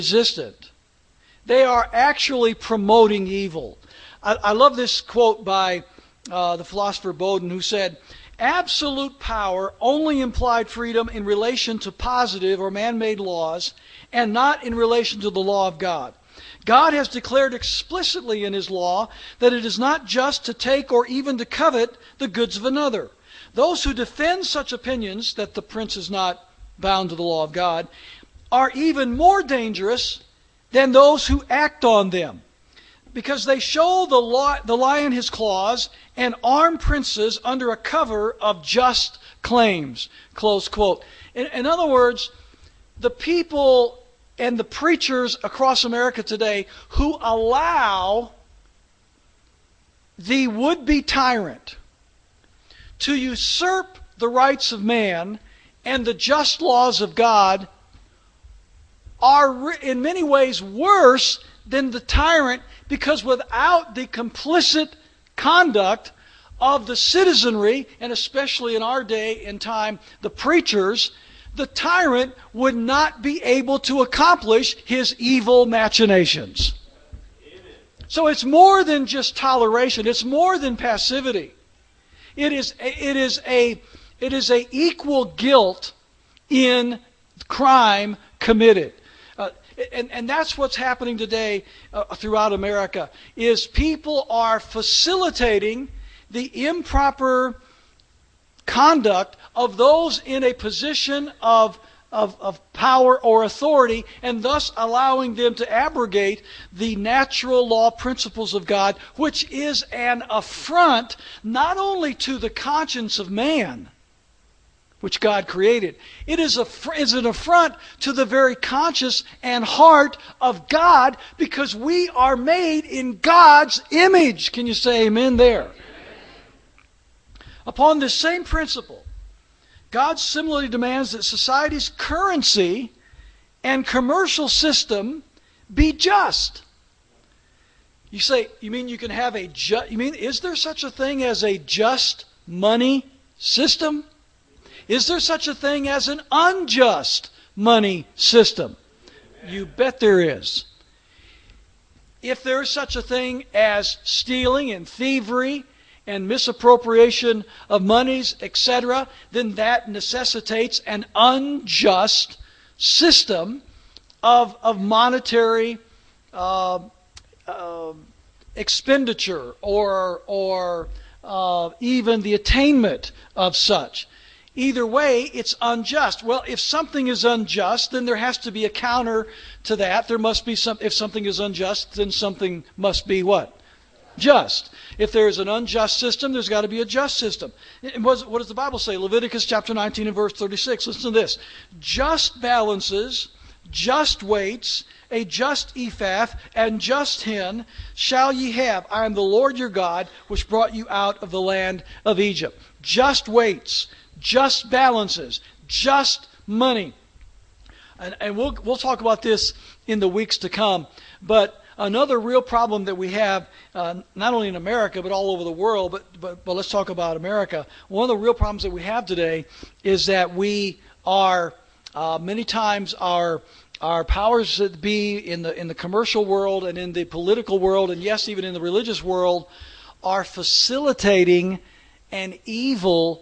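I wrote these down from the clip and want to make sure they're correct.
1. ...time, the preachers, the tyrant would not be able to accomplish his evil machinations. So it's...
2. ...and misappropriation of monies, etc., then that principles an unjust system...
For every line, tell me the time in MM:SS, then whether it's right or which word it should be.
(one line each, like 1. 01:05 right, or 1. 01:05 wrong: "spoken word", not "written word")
1. 01:09 right
2. 02:36 wrong: "necessitates", not "principles".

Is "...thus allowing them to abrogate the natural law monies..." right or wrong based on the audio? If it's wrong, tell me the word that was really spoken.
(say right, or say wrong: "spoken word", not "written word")
wrong: "principles", not "monies".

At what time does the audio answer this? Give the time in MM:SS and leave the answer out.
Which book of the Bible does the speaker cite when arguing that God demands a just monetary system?
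03:08.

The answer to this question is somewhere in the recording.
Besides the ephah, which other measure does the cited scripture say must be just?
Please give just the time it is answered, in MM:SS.
03:17.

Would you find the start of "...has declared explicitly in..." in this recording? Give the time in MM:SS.
00:16.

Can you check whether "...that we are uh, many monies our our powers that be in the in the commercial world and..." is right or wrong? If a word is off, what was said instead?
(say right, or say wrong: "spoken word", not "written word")
wrong: "times", not "monies".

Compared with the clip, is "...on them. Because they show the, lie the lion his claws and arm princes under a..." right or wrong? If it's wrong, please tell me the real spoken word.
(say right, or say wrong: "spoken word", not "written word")
right.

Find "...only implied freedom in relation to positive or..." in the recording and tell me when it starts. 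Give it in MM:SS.
00:09.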